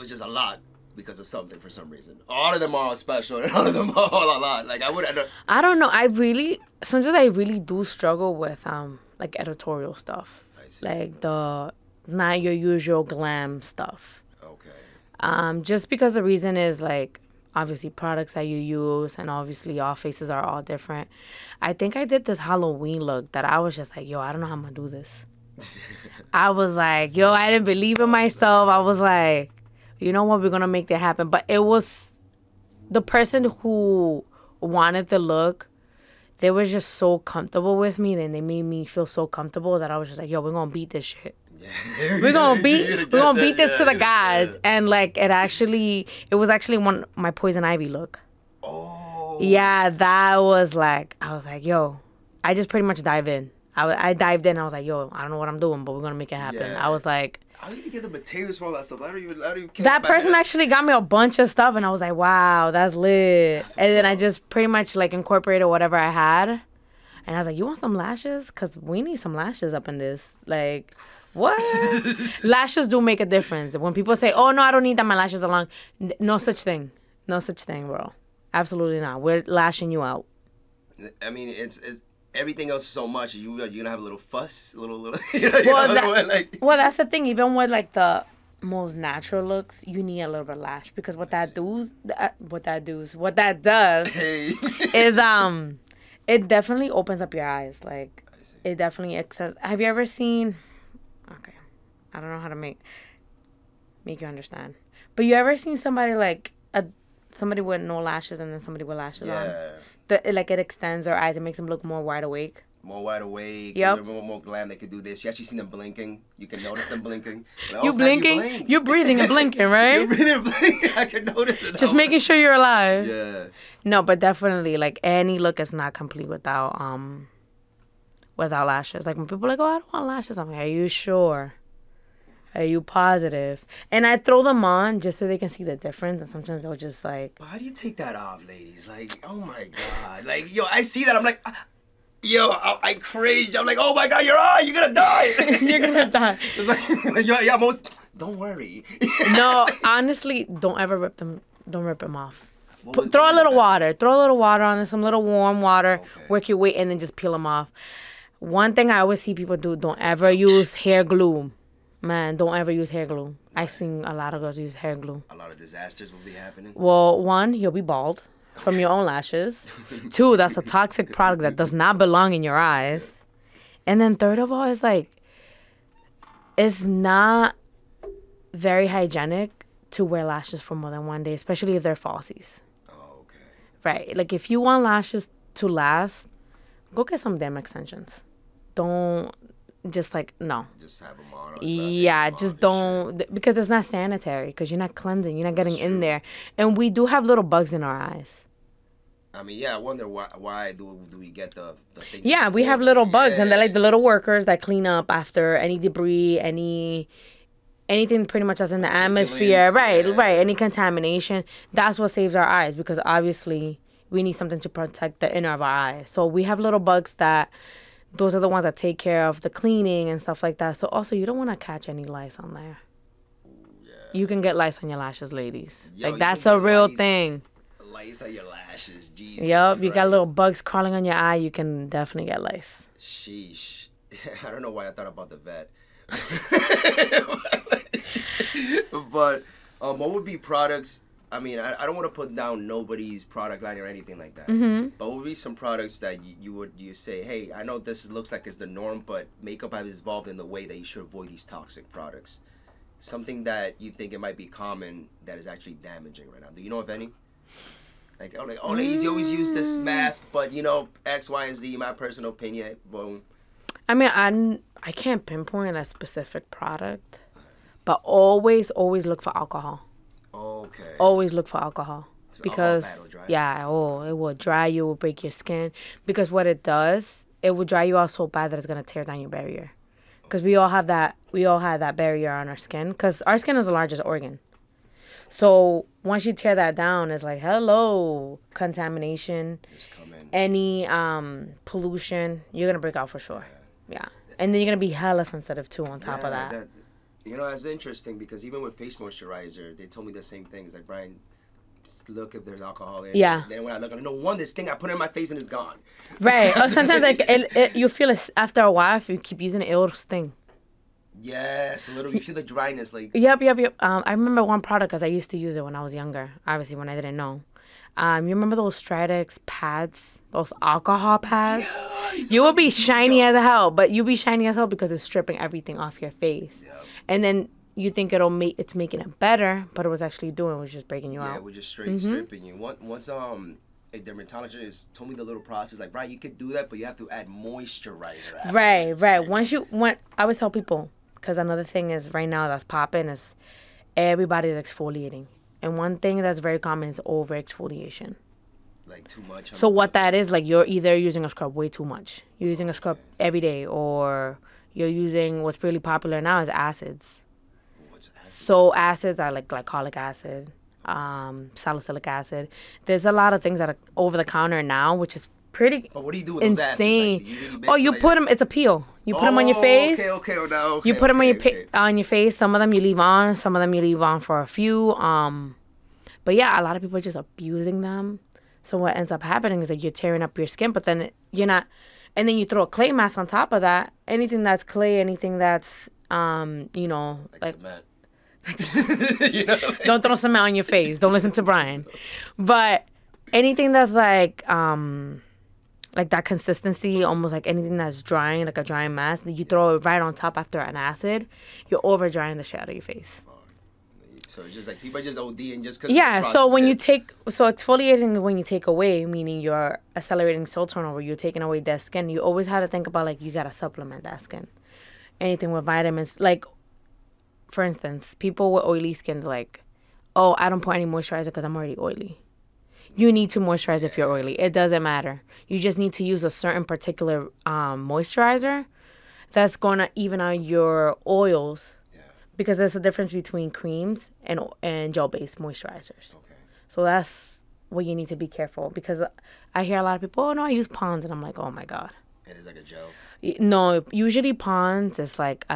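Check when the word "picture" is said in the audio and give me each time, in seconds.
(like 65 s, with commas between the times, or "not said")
not said.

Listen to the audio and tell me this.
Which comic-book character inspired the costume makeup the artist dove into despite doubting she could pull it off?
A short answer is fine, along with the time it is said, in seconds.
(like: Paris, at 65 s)
Poison Ivy, at 47 s.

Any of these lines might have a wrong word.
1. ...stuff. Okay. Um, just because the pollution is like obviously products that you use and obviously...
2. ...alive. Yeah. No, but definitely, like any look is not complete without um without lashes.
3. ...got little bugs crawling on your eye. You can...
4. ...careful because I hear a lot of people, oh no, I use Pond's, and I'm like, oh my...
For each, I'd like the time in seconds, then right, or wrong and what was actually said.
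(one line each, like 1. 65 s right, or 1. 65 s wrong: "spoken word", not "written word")
1. 13 s wrong: "reason", not "pollution"
2. 122 s right
3. 229 s right
4. 438 s right.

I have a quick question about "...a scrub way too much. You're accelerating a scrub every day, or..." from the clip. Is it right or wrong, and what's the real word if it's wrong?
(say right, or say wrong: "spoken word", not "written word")
wrong: "using", not "accelerating".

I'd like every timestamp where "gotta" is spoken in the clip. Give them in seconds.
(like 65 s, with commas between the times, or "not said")
413 s.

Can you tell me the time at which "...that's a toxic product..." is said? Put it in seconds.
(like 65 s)
170 s.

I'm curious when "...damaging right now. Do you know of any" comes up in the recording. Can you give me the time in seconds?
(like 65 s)
255 s.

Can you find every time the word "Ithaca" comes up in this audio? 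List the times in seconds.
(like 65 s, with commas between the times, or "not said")
not said.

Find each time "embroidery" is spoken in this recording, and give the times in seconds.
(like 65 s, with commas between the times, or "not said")
not said.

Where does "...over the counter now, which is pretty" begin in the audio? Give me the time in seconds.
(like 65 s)
363 s.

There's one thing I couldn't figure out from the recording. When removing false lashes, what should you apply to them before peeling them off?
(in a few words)
Warm water.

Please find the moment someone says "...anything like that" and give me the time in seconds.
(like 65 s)
243 s.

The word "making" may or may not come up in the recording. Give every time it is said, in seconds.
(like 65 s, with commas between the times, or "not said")
121 s, 328 s.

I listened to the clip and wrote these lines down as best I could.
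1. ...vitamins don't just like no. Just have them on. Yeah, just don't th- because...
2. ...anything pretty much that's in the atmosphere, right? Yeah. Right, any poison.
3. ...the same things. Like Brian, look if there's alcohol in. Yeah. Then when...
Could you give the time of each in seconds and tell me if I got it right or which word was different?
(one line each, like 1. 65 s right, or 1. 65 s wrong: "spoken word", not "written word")
1. 187 s wrong: "extensions", not "vitamins"
2. 207 s wrong: "contamination", not "poison"
3. 300 s right.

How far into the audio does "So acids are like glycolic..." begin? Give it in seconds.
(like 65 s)
358 s.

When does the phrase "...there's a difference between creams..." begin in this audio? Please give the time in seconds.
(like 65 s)
432 s.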